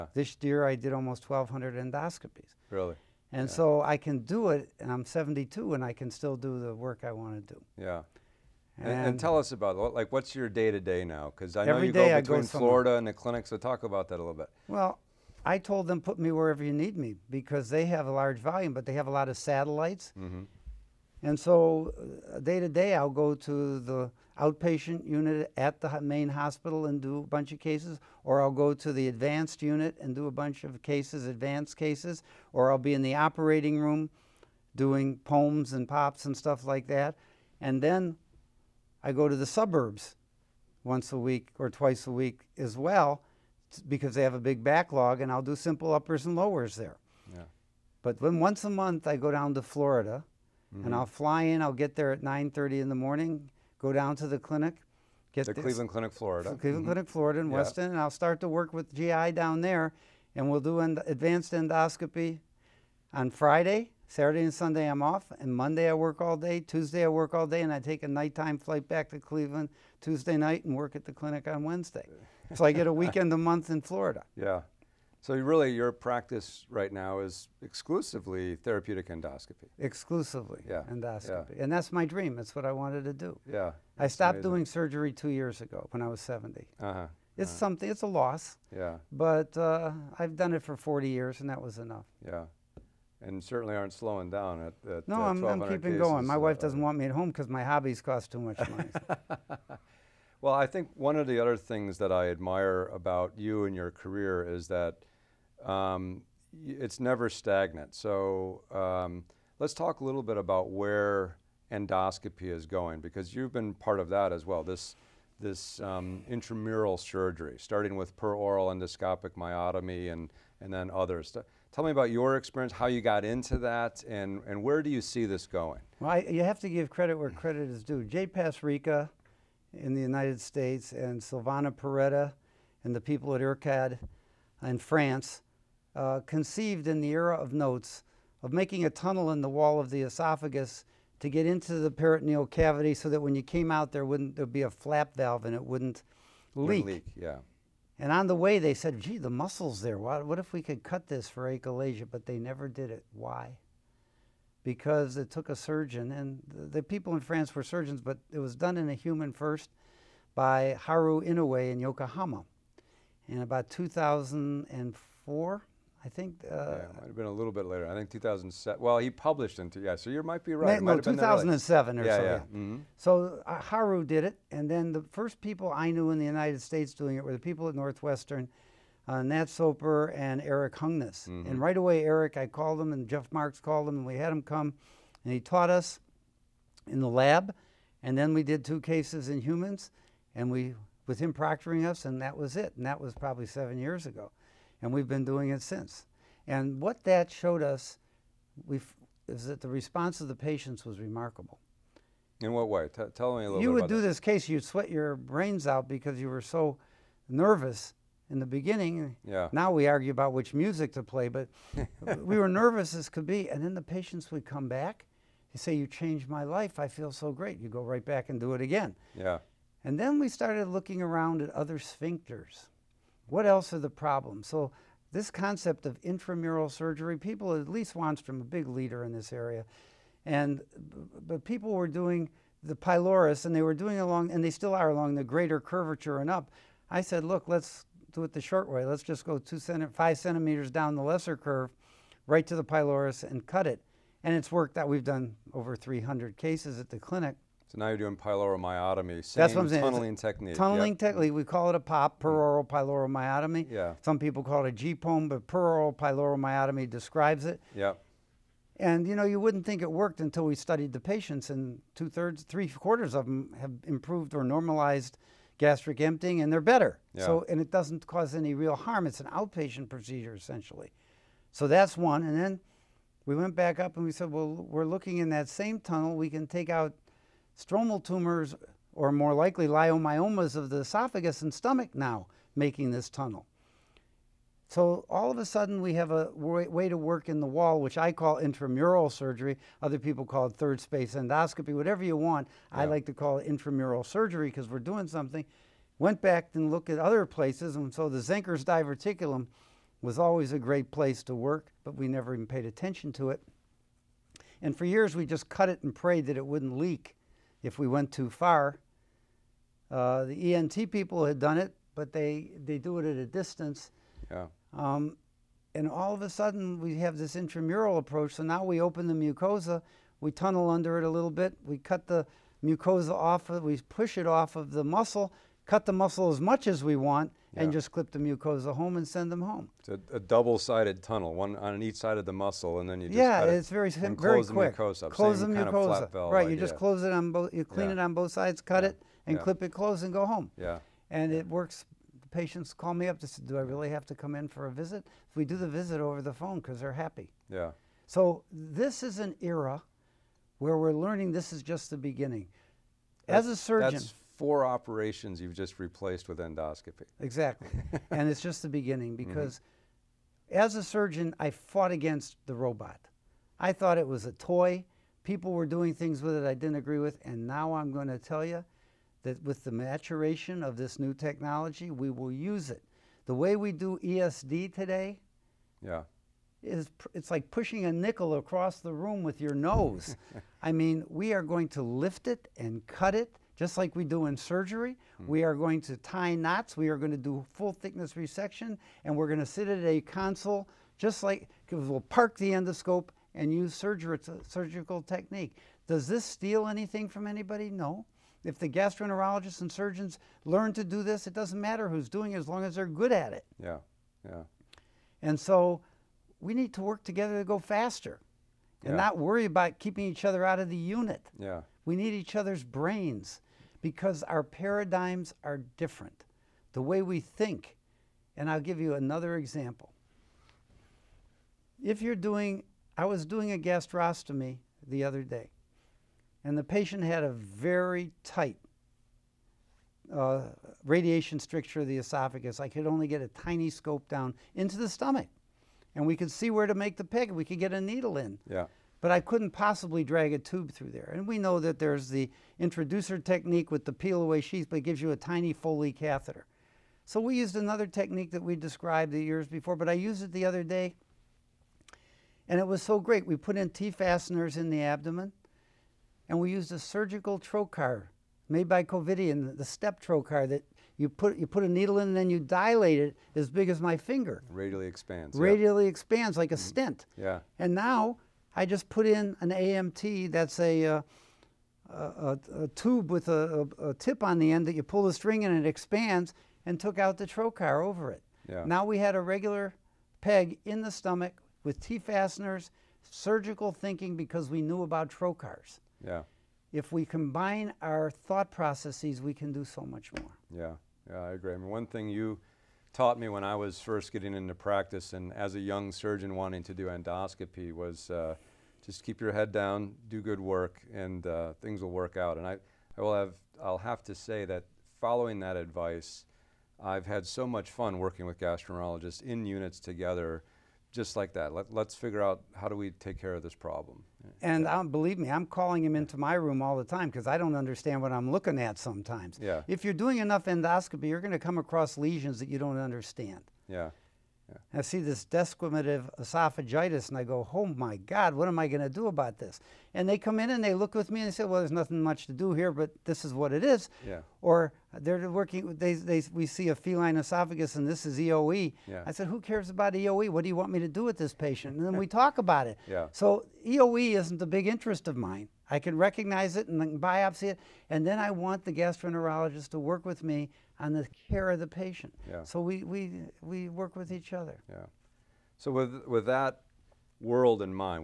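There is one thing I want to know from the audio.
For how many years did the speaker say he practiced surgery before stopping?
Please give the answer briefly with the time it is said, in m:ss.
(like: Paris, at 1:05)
40 years, at 1:30.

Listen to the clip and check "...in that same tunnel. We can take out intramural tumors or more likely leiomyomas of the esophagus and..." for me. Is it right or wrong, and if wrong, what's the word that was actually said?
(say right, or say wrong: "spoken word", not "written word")
wrong: "stromal", not "intramural".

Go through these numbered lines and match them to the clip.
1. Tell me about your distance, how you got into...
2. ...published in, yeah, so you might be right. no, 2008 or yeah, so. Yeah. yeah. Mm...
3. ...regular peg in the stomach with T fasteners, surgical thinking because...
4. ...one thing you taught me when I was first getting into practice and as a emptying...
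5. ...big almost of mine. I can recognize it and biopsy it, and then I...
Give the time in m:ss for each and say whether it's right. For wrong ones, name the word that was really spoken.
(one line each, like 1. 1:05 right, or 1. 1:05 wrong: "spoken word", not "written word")
1. 2:01 wrong: "experience", not "distance"
2. 2:49 wrong: "2007", not "2008"
3. 7:59 right
4. 8:11 wrong: "young", not "emptying"
5. 9:04 wrong: "interest", not "almost".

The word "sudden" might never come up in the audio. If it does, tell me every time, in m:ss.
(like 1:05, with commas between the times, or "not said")
4:45, 5:16.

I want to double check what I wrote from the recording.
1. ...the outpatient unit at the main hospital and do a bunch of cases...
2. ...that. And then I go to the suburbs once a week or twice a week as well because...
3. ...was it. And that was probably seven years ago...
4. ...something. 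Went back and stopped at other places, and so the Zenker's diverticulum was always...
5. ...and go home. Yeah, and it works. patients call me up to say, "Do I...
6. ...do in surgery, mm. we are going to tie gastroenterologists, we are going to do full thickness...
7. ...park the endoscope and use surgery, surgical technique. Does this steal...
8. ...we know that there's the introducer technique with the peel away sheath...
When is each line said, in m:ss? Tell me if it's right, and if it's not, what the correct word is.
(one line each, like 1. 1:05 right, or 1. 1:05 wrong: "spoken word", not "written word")
1. 0:23 right
2. 0:36 right
3. 3:12 right
4. 4:55 wrong: "looked", not "stopped"
5. 5:40 right
6. 6:24 wrong: "knots", not "gastroenterologists"
7. 6:32 right
8. 7:21 right.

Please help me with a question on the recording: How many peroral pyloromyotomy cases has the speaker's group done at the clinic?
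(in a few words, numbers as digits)
over 300.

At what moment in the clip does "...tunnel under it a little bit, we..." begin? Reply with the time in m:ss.
5:20.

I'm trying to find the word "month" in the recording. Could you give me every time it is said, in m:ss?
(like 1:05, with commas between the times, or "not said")
0:48, 1:13.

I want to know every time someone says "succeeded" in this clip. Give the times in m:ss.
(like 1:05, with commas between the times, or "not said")
not said.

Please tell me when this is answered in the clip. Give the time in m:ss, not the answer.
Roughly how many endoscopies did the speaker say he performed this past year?
0:00.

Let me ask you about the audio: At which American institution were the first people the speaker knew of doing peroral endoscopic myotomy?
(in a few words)
Northwestern.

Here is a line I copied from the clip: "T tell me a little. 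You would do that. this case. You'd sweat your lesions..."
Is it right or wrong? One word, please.
wrong.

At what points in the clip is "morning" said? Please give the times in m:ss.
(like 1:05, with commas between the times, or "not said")
0:52.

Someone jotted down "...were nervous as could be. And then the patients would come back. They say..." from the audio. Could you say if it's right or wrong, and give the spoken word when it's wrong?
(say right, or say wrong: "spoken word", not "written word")
right.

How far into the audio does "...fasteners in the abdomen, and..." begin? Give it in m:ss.
7:33.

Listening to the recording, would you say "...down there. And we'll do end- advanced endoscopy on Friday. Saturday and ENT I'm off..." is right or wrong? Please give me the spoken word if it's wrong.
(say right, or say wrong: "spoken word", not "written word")
wrong: "Sunday", not "ENT".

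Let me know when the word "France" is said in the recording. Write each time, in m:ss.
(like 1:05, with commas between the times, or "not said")
2:14, 2:37.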